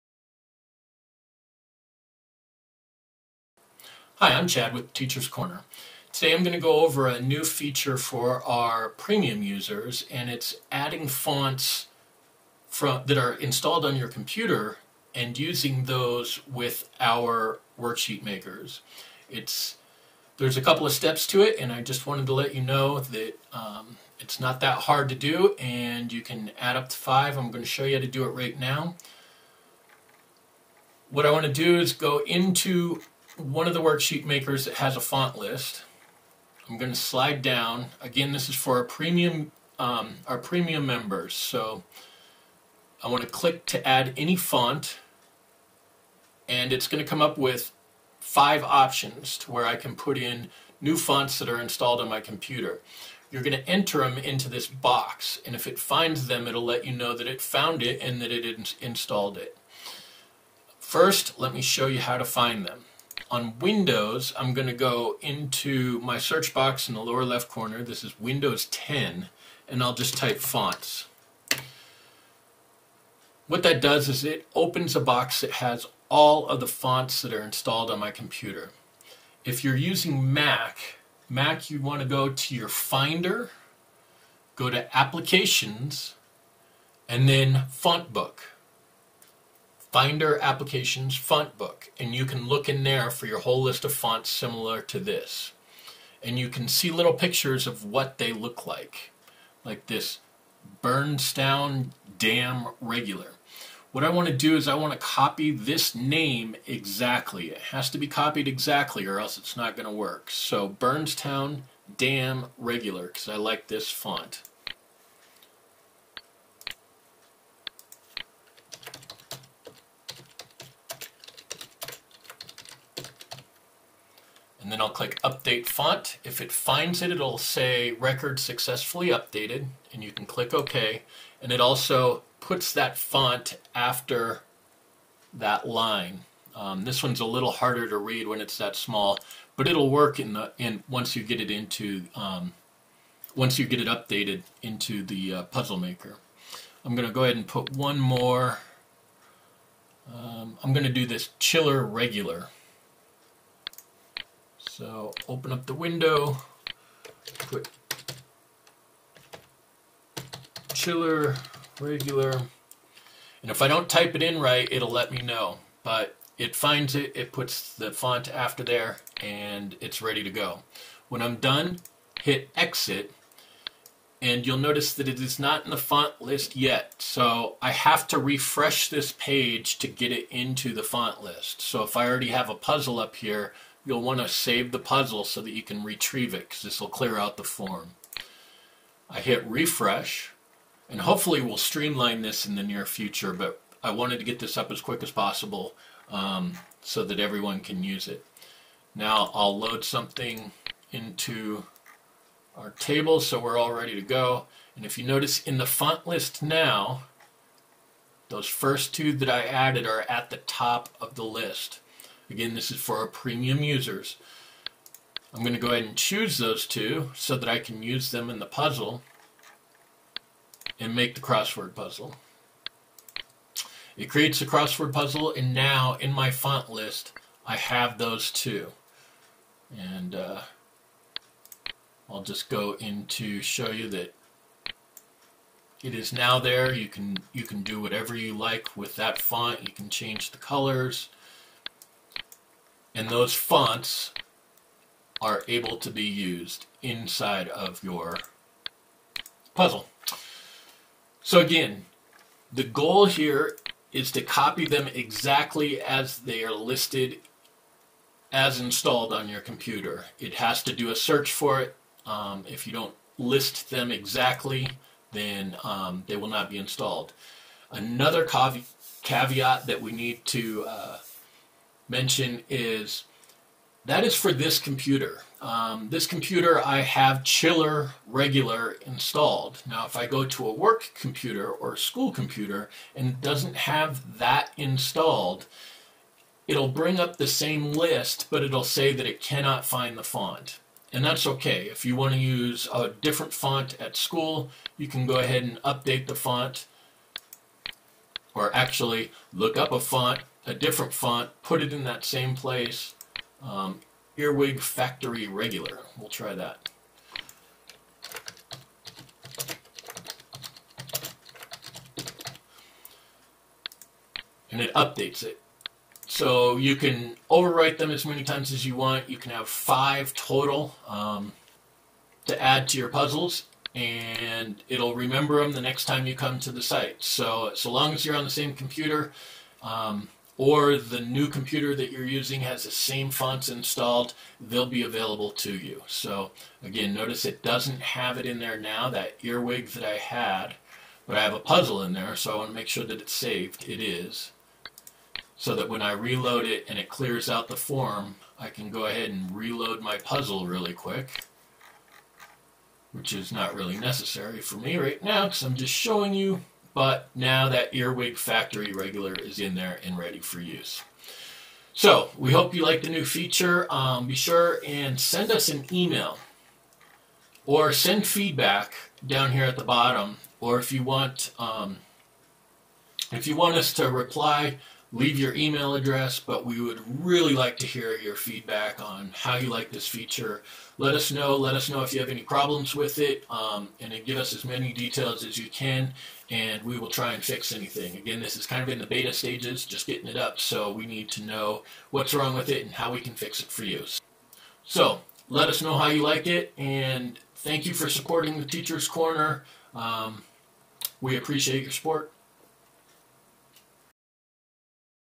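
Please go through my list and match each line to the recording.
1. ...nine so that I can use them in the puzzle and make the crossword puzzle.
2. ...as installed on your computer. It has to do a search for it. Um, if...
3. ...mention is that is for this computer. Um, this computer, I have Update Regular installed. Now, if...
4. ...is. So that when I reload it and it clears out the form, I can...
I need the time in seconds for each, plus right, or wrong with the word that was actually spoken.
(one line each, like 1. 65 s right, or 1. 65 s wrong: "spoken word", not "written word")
1. 216 s wrong: "two", not "nine"
2. 258 s right
3. 271 s wrong: "Chiller", not "Update"
4. 343 s right.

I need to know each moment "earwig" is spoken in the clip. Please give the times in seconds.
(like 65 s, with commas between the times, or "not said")
304 s, 339 s, 357 s.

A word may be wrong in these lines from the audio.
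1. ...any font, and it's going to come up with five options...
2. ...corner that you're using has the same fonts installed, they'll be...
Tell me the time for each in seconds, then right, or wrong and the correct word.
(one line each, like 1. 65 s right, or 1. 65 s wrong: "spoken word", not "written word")
1. 44 s right
2. 331 s wrong: "computer", not "corner".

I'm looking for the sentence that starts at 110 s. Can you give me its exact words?
So Burnstown Dam Regular, because I like this font.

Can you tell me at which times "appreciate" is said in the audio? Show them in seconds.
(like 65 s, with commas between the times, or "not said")
401 s.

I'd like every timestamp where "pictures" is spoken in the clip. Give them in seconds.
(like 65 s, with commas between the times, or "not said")
97 s.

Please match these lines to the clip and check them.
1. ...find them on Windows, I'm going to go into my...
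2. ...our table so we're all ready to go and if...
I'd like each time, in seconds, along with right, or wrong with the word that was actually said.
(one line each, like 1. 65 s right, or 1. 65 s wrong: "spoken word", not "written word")
1. 62 s right
2. 202 s right.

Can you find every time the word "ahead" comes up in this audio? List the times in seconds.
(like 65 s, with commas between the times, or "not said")
147 s, 215 s, 295 s, 348 s.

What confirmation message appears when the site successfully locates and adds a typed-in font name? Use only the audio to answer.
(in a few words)
Record Successfully Updated.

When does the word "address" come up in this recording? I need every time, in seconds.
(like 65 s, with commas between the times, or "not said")
375 s.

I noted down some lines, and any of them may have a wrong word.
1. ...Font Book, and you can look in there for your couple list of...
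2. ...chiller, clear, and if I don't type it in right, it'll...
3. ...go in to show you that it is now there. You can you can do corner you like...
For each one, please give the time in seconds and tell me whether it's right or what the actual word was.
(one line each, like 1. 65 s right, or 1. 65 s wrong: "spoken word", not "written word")
1. 91 s wrong: "whole", not "couple"
2. 160 s wrong: "regular", not "clear"
3. 232 s wrong: "whatever", not "corner".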